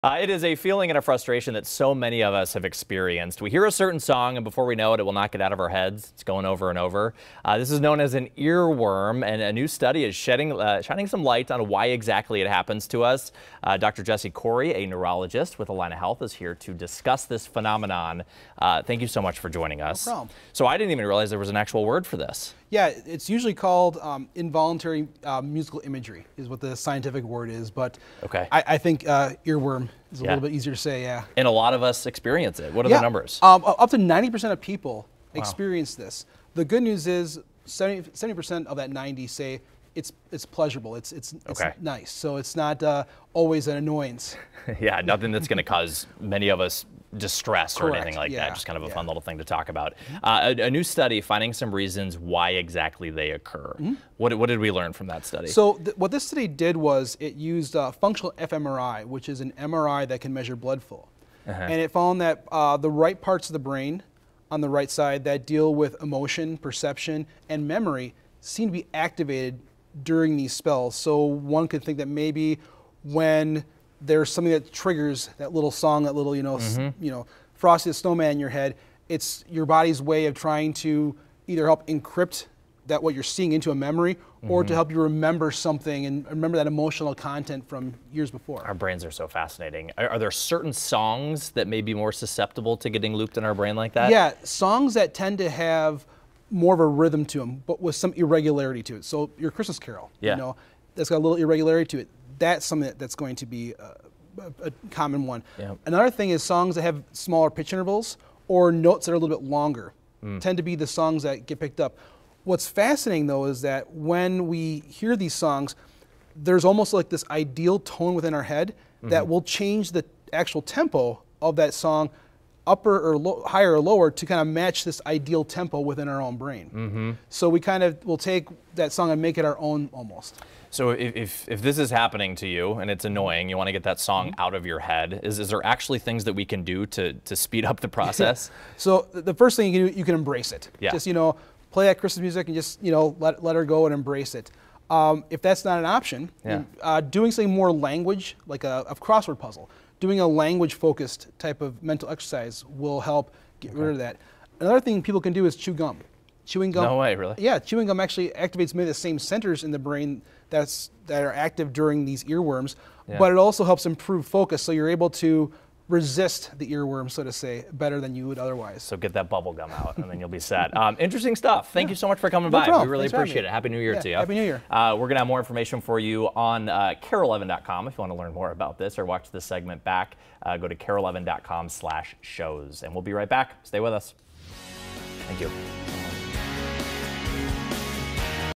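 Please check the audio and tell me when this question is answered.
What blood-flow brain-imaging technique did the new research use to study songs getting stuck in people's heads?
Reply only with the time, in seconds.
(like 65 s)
58 s.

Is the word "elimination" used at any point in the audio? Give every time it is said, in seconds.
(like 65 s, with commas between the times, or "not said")
not said.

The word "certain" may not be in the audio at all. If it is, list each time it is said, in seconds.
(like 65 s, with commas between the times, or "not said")
3 s, 90 s.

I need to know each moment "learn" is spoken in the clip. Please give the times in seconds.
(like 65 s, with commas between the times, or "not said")
54 s, 178 s.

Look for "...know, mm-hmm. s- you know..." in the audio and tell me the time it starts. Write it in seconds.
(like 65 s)
76 s.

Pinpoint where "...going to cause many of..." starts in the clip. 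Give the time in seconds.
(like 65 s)
45 s.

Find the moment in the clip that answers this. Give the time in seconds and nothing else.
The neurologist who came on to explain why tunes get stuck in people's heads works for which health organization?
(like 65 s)
15 s.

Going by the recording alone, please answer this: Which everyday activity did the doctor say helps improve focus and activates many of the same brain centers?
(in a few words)
chew gum.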